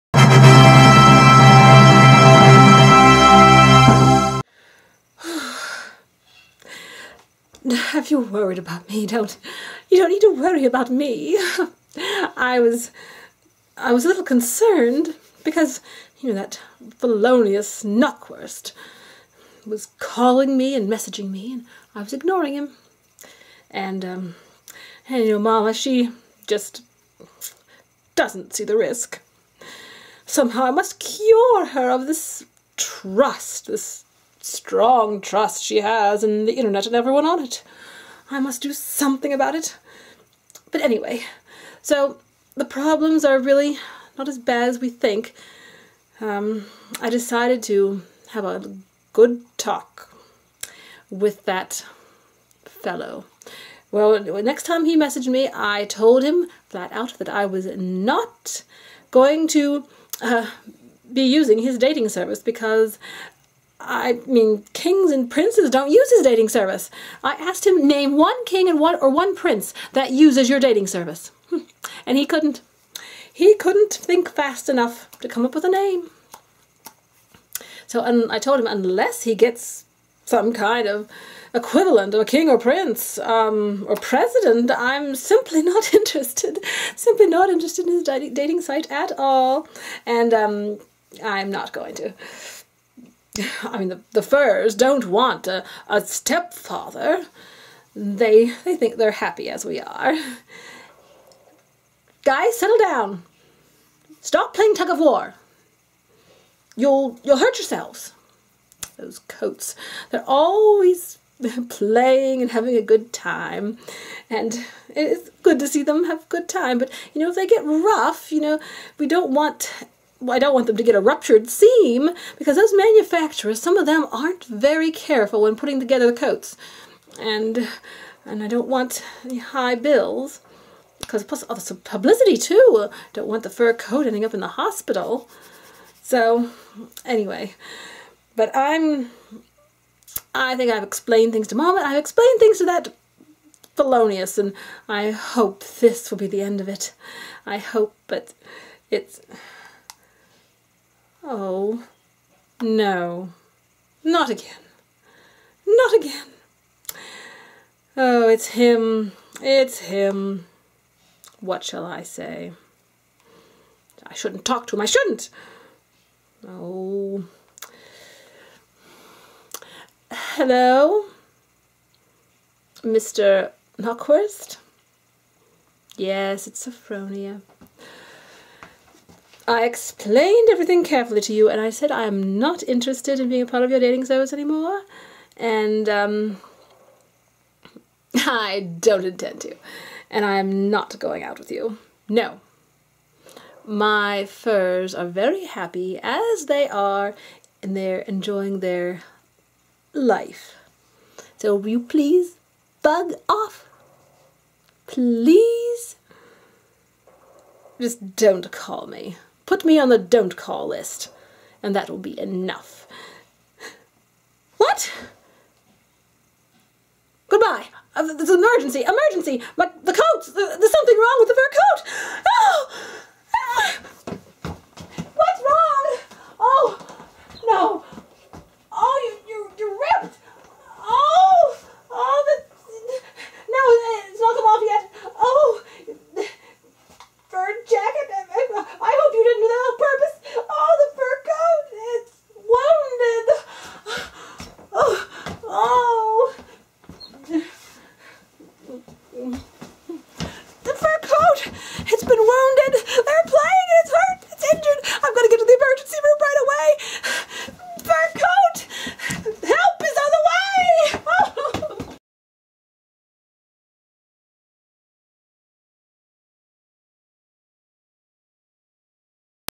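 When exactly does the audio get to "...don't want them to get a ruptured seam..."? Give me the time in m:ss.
2:00.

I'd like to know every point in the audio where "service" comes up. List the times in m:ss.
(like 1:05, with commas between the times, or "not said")
1:02, 1:06, 1:10, 3:04.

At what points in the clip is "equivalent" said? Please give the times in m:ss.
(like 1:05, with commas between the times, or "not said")
1:21.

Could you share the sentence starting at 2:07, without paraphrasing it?
And and I don't want high bills because plus all the publicity too.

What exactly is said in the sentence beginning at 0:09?
Don't you don't need to worry about me.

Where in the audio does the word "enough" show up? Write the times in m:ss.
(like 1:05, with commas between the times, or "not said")
1:14, 3:32.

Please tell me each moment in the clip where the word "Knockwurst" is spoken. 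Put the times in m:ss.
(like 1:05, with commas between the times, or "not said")
0:17, 2:53.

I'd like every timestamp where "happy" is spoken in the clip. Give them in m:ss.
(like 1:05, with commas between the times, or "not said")
1:39, 3:15.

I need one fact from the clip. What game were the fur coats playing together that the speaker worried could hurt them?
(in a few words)
tug of war.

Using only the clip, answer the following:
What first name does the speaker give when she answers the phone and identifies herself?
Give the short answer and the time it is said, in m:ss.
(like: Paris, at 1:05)
Sophronia, at 2:56.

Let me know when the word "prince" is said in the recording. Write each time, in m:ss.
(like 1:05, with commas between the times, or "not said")
1:05, 1:09, 1:22.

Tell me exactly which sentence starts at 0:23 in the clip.
And um and you know Mama she just doesn't see the risk.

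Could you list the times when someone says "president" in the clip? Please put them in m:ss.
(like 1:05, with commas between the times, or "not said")
1:23.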